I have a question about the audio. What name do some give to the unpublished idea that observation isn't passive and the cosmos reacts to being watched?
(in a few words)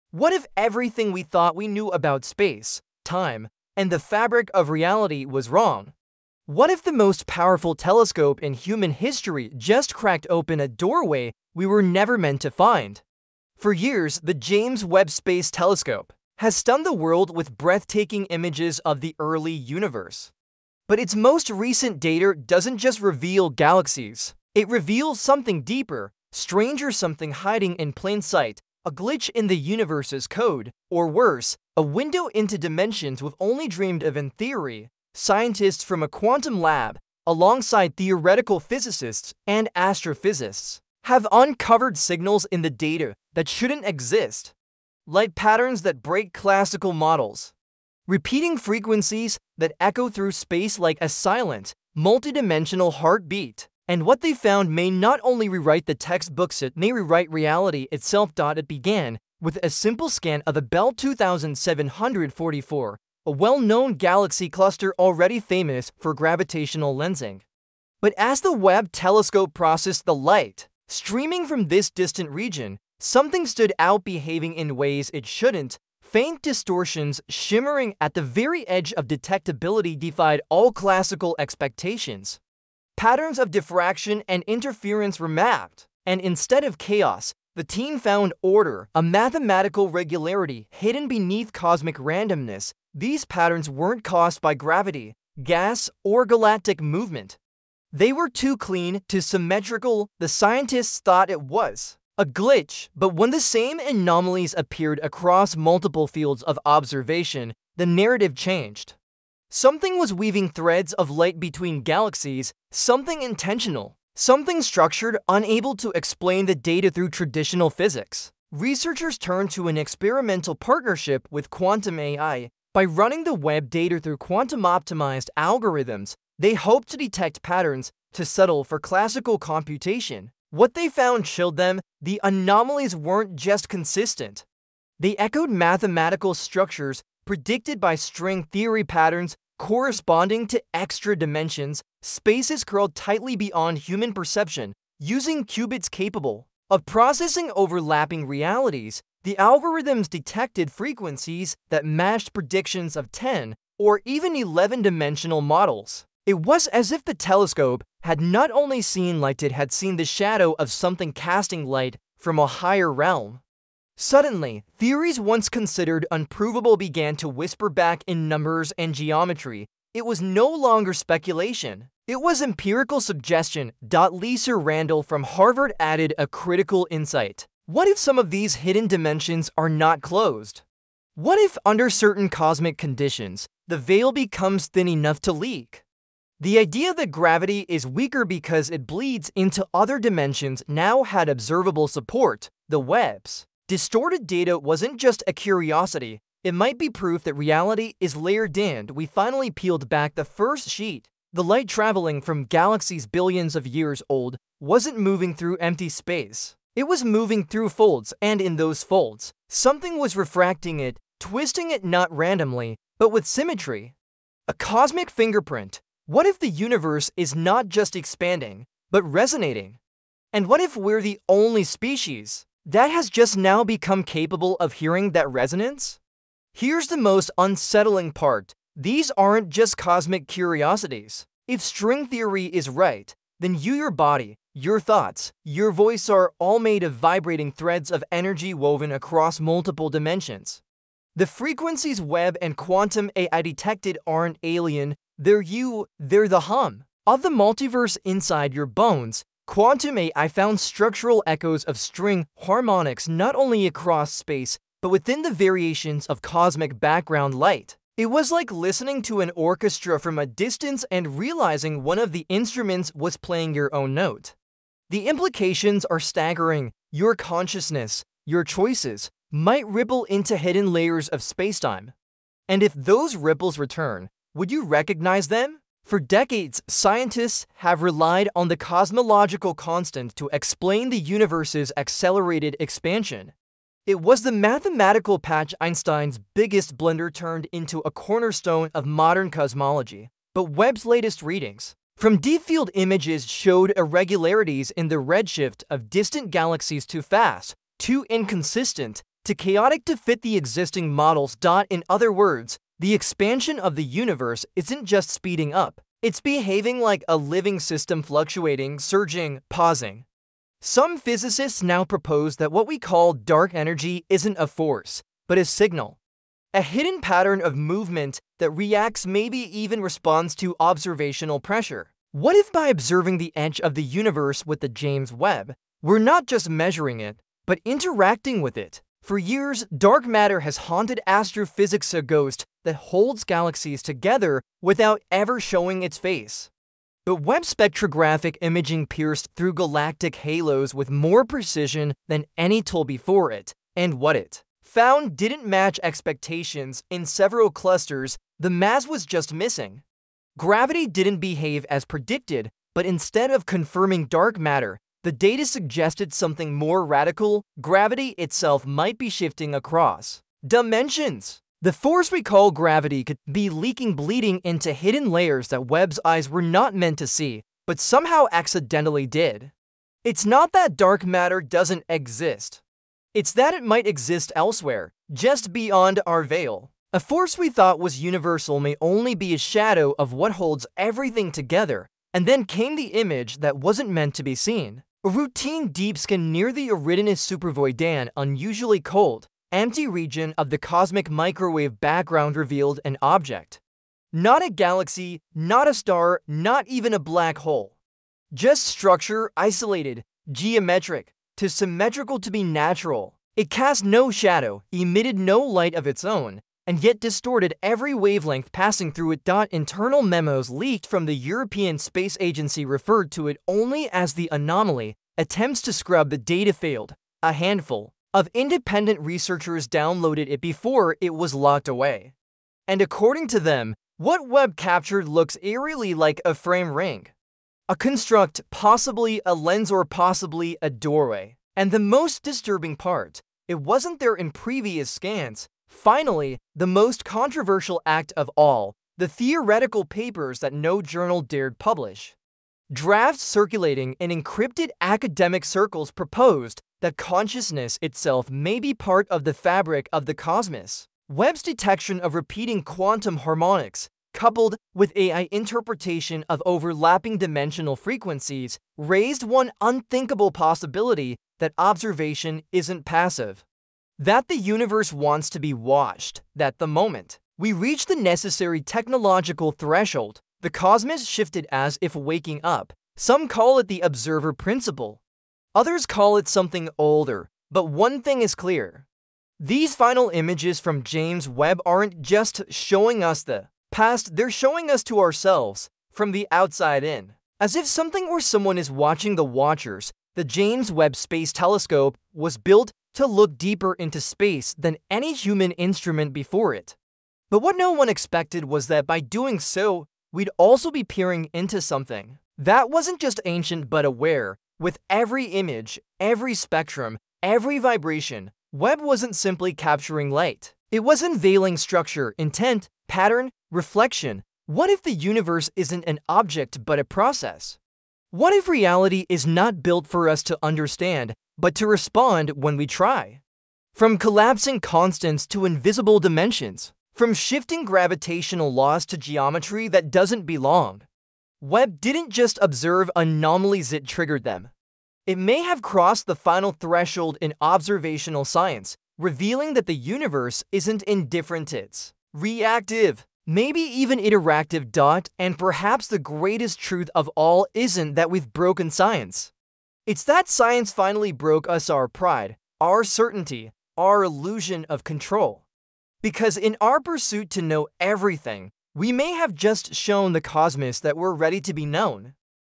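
observer principle.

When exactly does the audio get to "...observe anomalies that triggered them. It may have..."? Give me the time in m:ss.
8:52.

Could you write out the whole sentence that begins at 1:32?
These patterns weren't caused by gravity, gas, or galactic movement.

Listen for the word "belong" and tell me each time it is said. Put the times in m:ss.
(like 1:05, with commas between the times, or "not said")
8:50.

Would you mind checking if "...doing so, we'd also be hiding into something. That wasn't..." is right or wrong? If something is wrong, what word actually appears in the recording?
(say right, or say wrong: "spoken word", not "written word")
wrong: "peering", not "hiding".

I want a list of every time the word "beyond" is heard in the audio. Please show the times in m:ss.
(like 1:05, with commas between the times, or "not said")
2:23, 6:15.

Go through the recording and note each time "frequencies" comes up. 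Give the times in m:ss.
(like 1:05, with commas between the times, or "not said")
0:48, 2:30, 4:01, 7:37.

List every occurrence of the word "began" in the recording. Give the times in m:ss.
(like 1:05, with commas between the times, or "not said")
0:58, 2:46.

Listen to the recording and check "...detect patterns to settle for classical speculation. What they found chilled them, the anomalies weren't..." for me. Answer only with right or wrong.
wrong.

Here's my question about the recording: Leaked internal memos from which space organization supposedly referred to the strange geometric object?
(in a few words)
European Space Agency.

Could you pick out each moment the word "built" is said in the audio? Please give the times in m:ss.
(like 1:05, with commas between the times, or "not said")
8:12, 8:39.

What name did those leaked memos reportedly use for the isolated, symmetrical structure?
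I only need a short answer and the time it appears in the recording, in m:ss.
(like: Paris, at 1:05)
the anomaly, at 6:54.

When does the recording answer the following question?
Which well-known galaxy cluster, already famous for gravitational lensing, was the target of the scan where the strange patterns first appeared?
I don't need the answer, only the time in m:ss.
1:00.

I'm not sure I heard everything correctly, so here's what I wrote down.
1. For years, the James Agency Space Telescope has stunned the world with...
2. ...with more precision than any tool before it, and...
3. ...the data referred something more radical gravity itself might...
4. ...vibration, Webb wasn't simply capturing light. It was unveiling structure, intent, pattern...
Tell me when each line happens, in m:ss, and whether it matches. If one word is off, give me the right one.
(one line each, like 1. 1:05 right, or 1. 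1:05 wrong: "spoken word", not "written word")
1. 0:13 wrong: "Webb", not "Agency"
2. 5:40 right
3. 5:55 wrong: "suggested", not "referred"
4. 8:27 right.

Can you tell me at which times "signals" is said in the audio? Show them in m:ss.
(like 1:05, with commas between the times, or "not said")
0:41, 5:15.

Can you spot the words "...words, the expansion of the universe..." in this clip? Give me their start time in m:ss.
5:02.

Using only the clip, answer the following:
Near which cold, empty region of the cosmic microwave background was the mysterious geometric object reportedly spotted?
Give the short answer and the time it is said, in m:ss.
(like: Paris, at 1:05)
Eridanus supervoid, at 6:26.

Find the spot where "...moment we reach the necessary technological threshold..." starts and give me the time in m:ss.
7:46.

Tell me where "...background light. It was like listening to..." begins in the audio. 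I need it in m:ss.
4:16.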